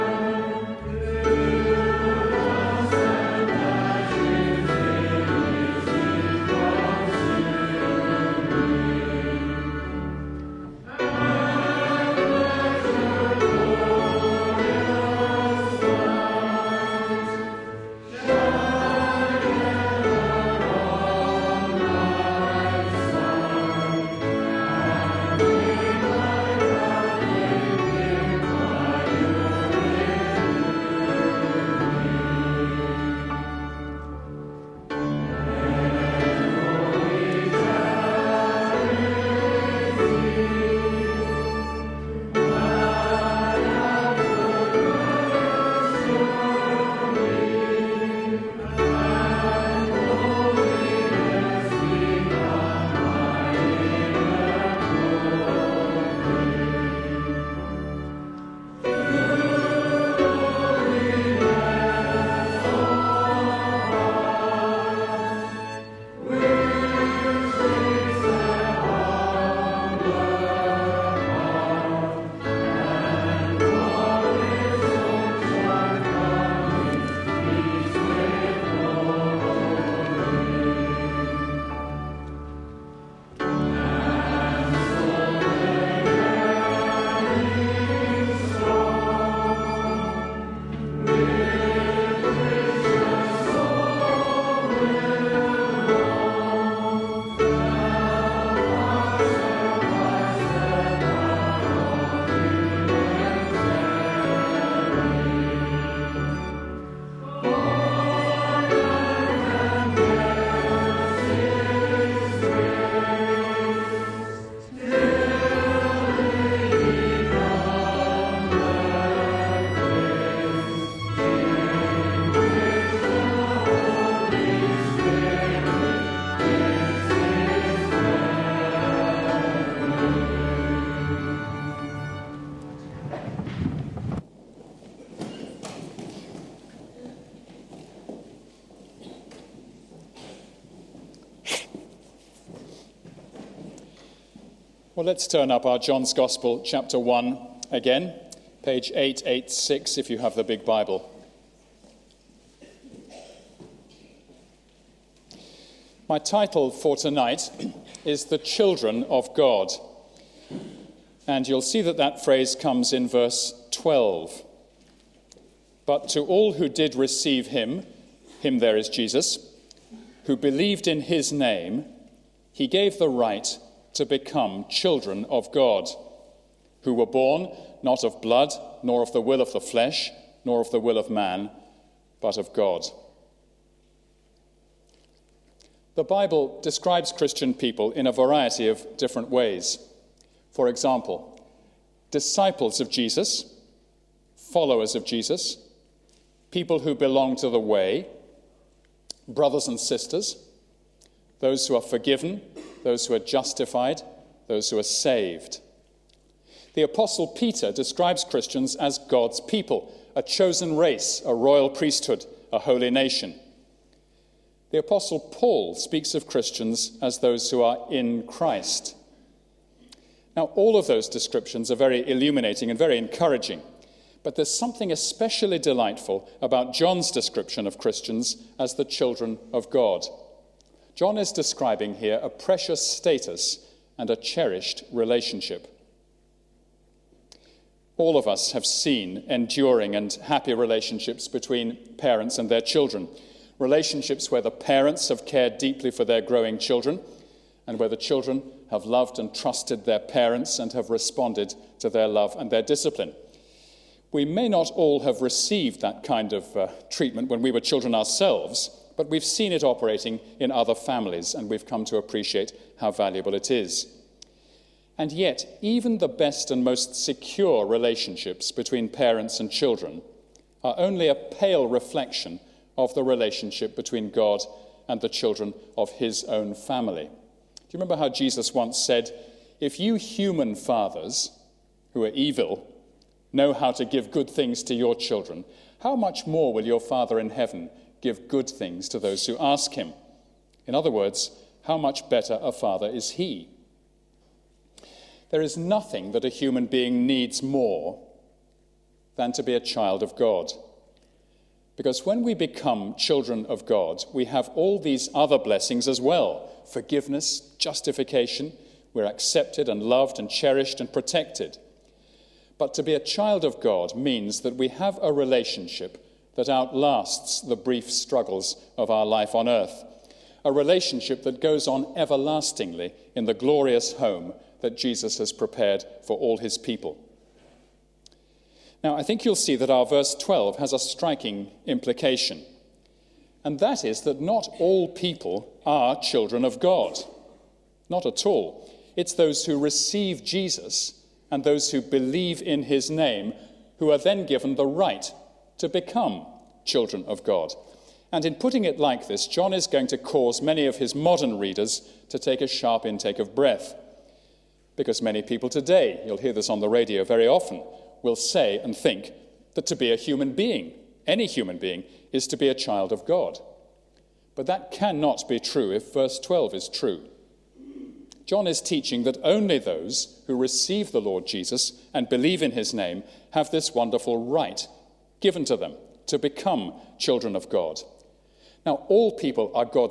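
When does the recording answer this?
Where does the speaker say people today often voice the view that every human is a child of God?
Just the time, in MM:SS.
05:56.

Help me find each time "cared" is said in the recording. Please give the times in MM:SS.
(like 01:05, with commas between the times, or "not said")
04:05.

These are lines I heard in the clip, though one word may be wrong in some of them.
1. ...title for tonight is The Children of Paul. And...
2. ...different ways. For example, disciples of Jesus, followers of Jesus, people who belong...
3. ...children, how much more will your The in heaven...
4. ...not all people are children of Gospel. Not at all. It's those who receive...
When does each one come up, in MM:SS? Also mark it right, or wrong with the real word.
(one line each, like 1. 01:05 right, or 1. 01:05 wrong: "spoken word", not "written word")
1. 02:36 wrong: "God", not "Paul"
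2. 03:08 right
3. 04:44 wrong: "Father", not "The"
4. 05:34 wrong: "God", not "Gospel".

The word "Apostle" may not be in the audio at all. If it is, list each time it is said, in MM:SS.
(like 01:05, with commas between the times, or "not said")
03:26, 03:34.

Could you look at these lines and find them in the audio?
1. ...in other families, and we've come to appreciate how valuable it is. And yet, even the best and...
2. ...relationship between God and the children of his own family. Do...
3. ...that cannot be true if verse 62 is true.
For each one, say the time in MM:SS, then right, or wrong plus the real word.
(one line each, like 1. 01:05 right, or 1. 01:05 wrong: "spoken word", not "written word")
1. 04:20 right
2. 04:33 right
3. 06:04 wrong: "12", not "62".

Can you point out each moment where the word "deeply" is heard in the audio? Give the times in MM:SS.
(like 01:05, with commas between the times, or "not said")
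04:05.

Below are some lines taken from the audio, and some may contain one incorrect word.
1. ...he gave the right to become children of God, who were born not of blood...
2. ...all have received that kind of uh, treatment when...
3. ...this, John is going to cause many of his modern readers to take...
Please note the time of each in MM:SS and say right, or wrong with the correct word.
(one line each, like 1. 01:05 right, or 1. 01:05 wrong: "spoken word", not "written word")
1. 02:52 right
2. 04:14 right
3. 05:49 right.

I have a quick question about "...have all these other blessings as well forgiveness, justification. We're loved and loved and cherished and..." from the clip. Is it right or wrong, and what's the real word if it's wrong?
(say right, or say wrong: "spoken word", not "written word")
wrong: "accepted", not "loved".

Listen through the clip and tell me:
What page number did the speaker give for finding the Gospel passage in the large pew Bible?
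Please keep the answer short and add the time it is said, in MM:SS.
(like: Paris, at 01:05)
886, at 02:28.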